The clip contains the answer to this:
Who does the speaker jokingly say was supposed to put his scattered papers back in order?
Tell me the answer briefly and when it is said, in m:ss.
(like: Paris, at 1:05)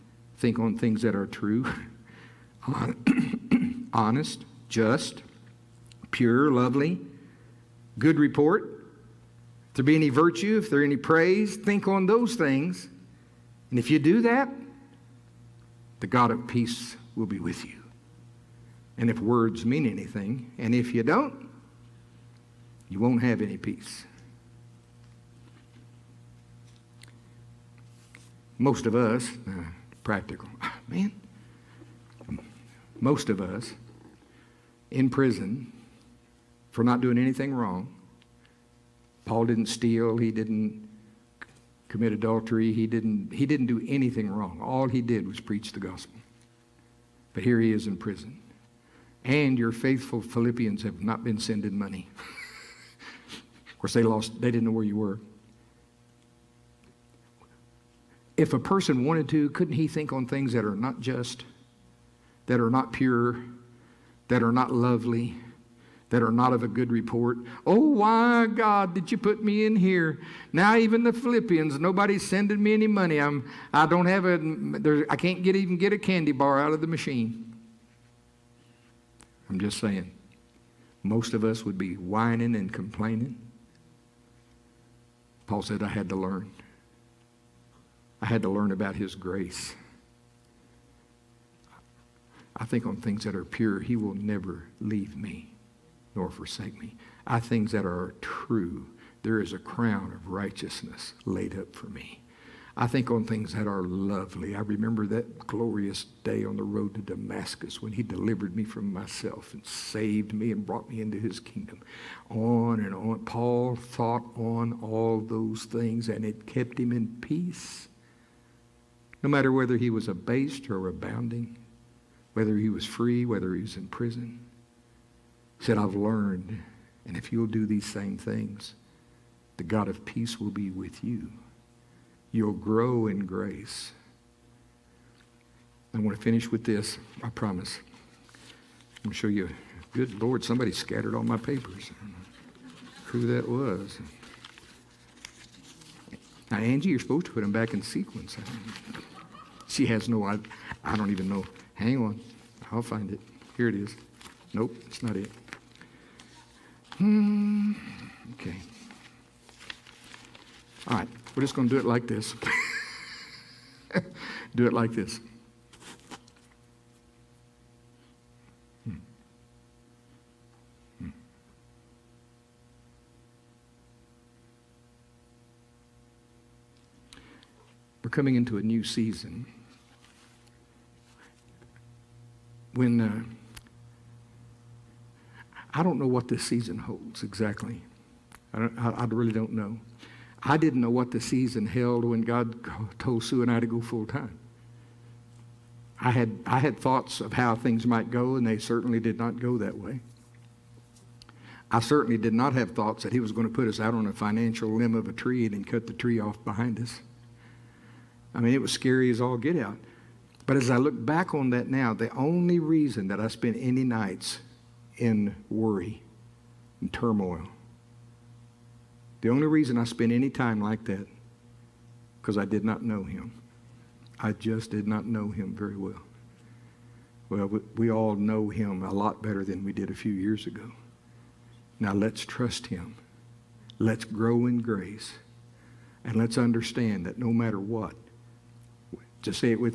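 Angie, at 2:26.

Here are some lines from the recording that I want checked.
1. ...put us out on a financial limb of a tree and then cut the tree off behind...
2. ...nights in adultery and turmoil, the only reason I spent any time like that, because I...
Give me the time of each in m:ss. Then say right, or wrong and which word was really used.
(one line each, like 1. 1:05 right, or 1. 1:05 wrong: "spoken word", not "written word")
1. 3:23 right
2. 3:33 wrong: "worry", not "adultery".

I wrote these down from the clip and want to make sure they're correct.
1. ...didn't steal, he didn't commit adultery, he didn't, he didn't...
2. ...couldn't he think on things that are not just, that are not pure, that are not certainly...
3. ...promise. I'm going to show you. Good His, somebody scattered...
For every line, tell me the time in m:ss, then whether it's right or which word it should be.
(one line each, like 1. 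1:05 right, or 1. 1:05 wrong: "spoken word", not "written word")
1. 0:39 right
2. 0:59 wrong: "lovely", not "certainly"
3. 2:17 wrong: "Lord", not "His".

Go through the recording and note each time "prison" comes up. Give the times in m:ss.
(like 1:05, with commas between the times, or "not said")
0:35, 0:47, 2:03.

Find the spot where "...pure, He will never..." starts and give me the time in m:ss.
1:33.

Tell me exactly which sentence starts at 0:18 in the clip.
And if words mean anything, and if you don't, you won't have any peace.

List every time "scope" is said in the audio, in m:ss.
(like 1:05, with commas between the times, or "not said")
not said.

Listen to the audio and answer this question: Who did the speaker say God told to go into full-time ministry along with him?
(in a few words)
Sue.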